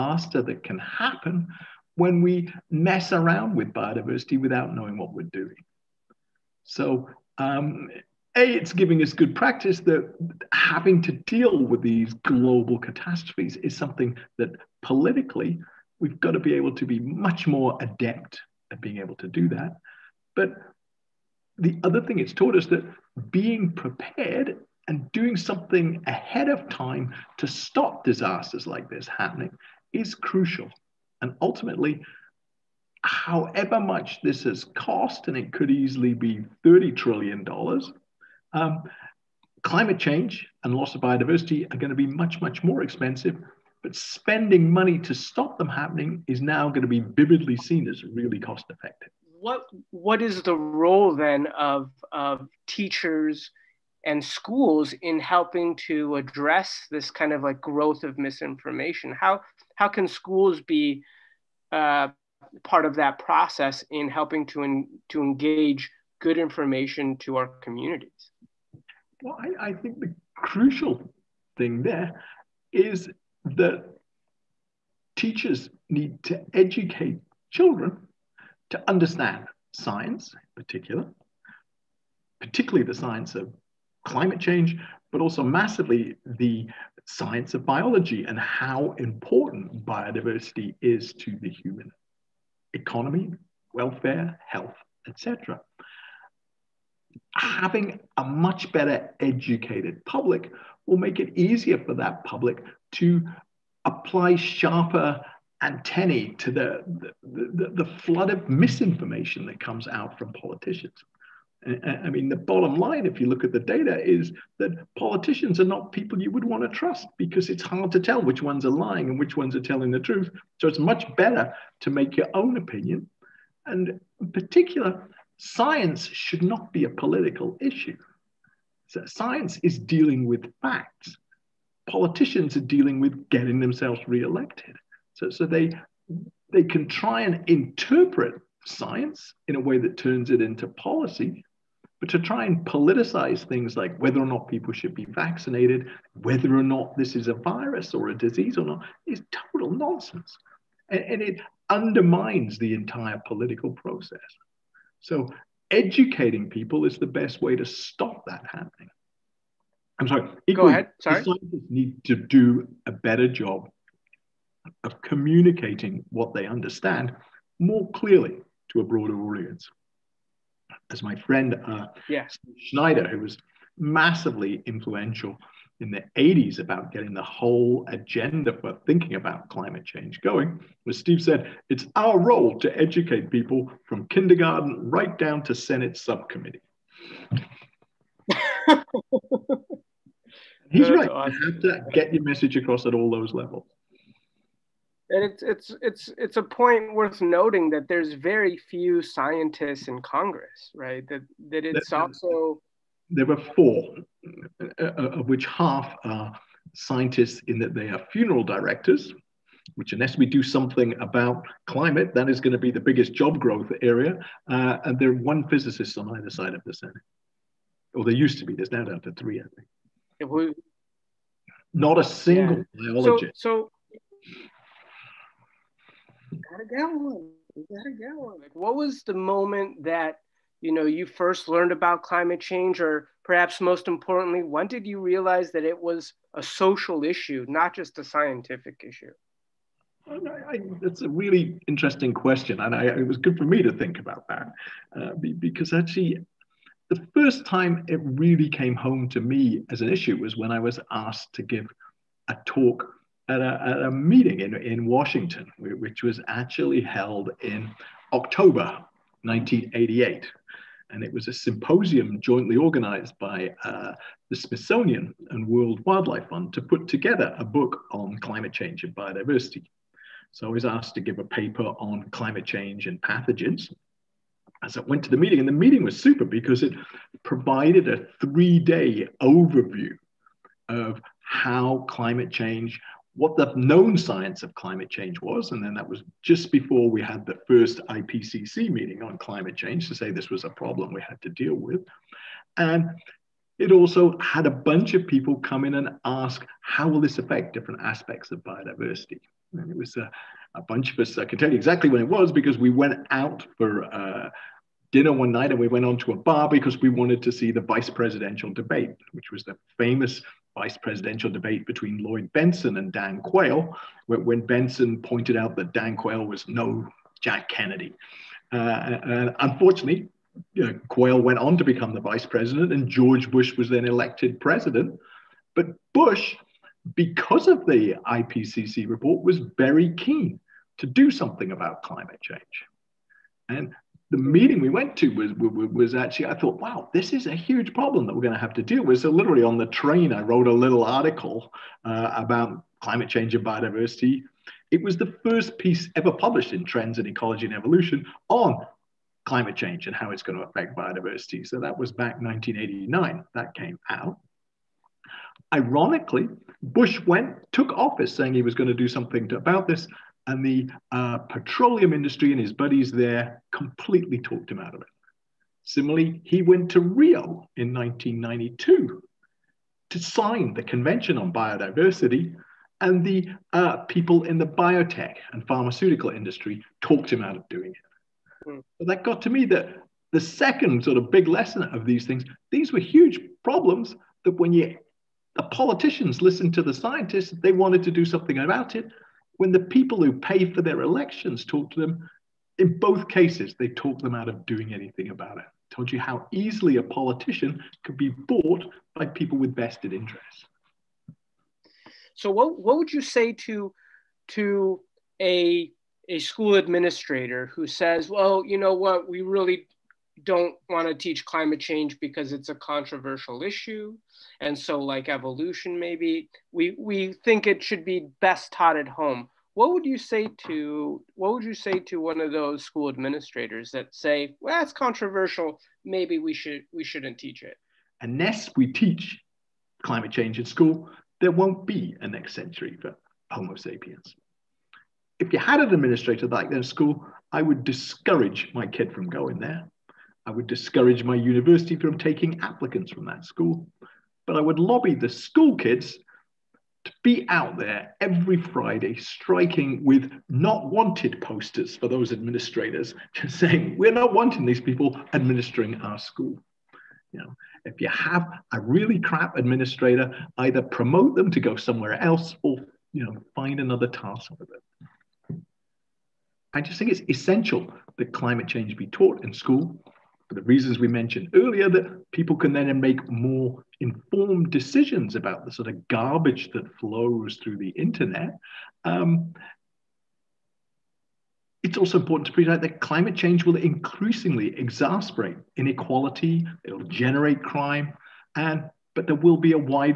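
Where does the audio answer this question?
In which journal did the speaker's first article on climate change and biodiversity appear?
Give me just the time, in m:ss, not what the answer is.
5:46.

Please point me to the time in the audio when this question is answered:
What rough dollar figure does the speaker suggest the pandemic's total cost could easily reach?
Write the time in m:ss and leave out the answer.
0:36.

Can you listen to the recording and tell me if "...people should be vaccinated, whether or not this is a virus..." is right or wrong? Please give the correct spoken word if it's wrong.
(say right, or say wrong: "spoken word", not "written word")
right.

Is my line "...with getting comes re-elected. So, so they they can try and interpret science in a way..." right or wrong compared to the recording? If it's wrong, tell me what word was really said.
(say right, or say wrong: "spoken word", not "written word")
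wrong: "themselves", not "comes".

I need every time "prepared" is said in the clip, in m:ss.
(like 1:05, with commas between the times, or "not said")
0:23.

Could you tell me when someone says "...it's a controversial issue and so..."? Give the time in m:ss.
6:52.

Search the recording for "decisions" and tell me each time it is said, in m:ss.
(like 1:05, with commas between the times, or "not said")
7:54.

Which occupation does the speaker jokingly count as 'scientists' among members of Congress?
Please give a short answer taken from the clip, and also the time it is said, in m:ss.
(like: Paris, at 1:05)
funeral directors, at 3:28.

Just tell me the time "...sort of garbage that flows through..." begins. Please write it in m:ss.
7:55.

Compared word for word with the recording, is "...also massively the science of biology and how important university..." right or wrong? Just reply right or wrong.
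wrong.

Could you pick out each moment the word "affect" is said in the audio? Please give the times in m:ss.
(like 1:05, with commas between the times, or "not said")
4:57, 5:50.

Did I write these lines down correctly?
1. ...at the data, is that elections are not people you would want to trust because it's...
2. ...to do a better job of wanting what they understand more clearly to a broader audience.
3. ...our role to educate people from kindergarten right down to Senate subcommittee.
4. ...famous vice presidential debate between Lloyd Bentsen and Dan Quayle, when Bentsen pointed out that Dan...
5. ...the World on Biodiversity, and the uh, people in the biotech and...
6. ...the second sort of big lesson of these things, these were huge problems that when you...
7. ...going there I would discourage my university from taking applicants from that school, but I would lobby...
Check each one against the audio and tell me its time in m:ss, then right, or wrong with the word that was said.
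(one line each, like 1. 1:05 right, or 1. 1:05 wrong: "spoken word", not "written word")
1. 1:53 wrong: "politicians", not "elections"
2. 2:42 wrong: "communicating", not "wanting"
3. 3:01 right
4. 5:09 right
5. 6:10 wrong: "Convention", not "World"
6. 6:20 right
7. 7:19 right.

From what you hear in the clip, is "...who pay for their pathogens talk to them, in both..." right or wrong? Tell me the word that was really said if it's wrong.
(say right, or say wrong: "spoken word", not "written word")
wrong: "elections", not "pathogens".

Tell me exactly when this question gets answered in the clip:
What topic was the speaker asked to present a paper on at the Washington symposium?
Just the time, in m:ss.
4:32.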